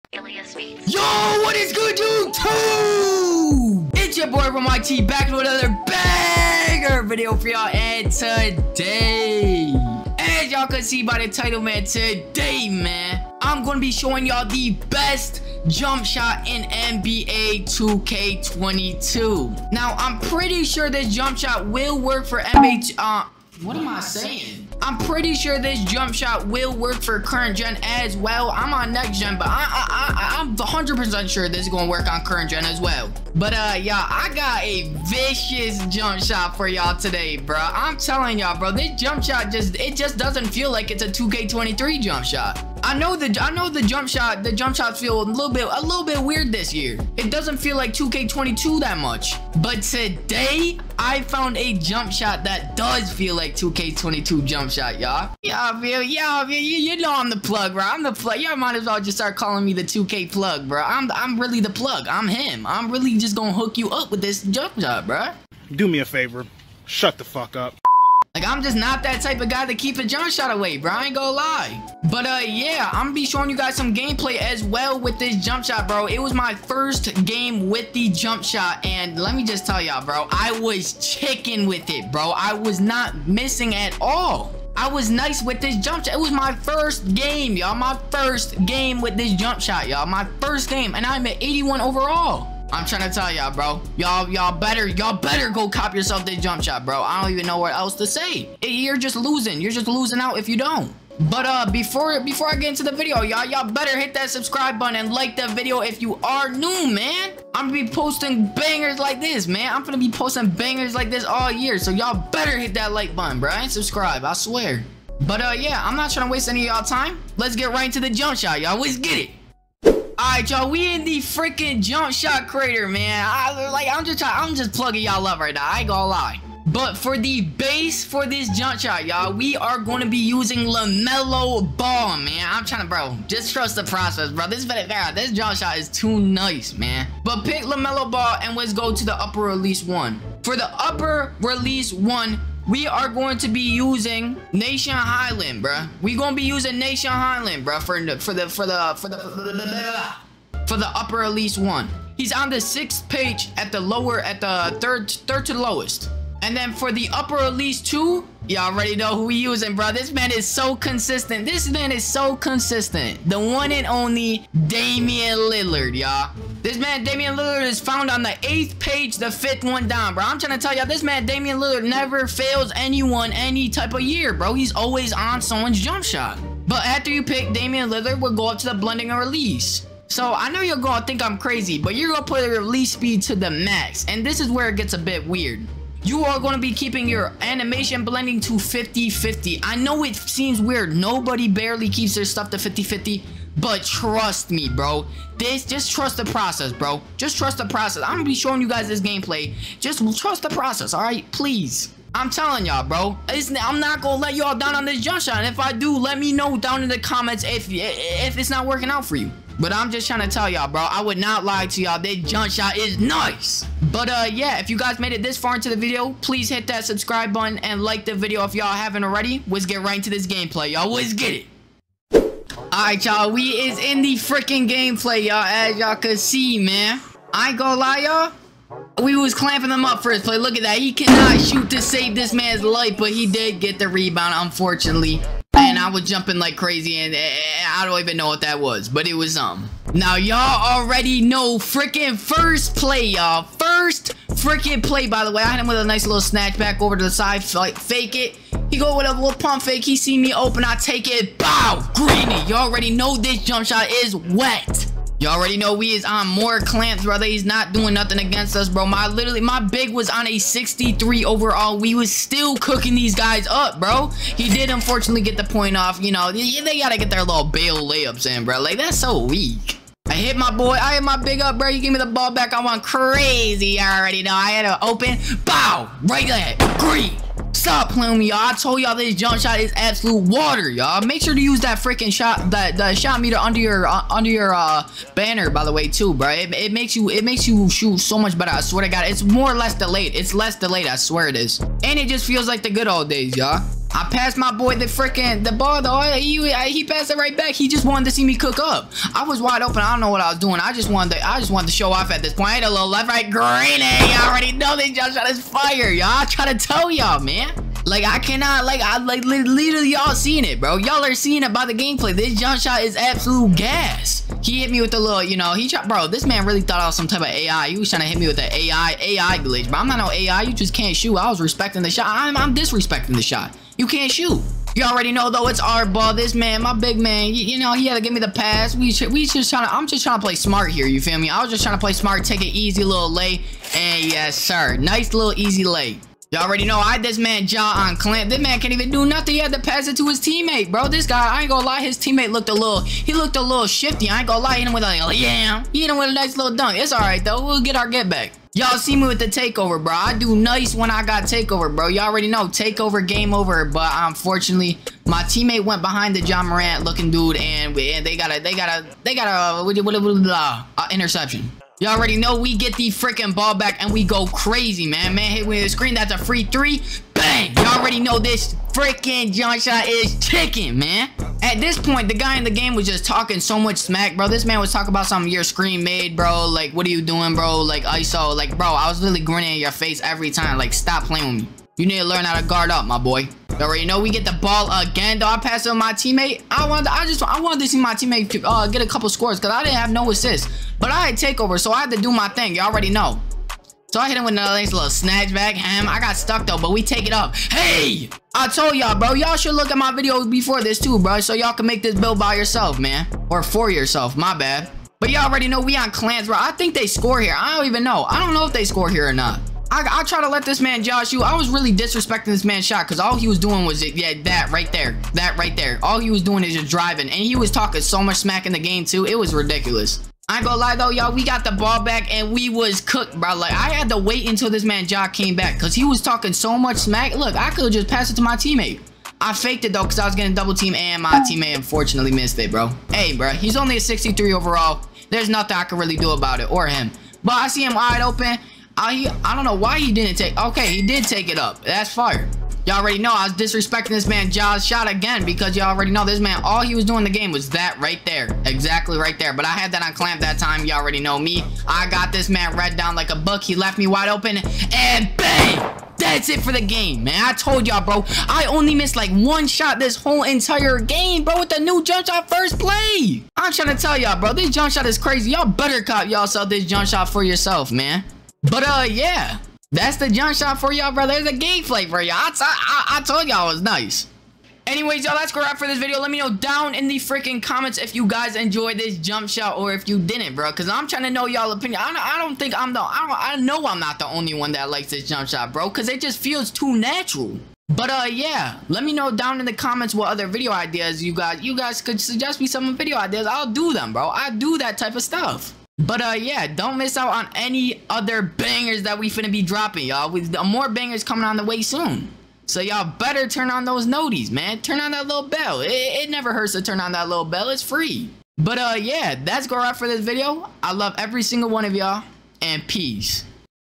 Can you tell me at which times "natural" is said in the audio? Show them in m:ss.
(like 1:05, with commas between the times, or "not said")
8:06.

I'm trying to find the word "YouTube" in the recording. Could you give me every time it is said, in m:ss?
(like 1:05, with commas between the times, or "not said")
0:01.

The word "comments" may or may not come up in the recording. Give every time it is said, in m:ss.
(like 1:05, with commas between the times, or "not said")
3:26, 7:57, 8:09.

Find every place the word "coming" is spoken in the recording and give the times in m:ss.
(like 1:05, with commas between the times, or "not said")
8:21.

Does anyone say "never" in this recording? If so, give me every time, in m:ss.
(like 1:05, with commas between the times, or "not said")
2:51, 8:26.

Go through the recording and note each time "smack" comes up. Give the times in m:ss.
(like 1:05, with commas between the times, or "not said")
6:13, 6:58, 7:06.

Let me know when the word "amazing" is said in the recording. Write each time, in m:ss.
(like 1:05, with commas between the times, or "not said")
not said.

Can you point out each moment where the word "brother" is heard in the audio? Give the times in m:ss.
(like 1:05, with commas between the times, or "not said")
4:17.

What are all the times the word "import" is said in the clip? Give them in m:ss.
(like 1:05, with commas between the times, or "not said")
not said.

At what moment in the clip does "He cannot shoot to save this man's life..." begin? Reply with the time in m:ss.
3:50.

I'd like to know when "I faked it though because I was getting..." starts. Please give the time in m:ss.
7:09.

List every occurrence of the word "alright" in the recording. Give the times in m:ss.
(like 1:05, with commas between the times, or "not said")
3:20, 3:42.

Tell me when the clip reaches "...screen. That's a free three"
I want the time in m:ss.
6:05.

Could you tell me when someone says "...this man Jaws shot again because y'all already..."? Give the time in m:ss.
7:23.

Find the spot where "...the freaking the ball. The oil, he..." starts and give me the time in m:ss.
4:54.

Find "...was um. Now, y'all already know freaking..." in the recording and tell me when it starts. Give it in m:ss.
3:59.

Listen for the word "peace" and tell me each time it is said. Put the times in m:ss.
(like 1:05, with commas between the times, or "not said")
8:32.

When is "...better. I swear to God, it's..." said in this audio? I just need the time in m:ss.
4:48.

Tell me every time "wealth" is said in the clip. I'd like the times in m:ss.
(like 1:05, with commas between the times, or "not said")
not said.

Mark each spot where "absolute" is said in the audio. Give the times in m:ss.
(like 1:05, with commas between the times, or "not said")
4:39, 5:12.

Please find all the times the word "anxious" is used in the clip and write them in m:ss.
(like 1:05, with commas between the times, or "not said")
not said.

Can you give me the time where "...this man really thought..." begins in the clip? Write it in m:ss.
5:16.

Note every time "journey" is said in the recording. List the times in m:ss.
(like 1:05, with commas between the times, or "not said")
not said.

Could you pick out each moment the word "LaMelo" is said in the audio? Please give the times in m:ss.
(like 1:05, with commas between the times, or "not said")
2:10, 2:17.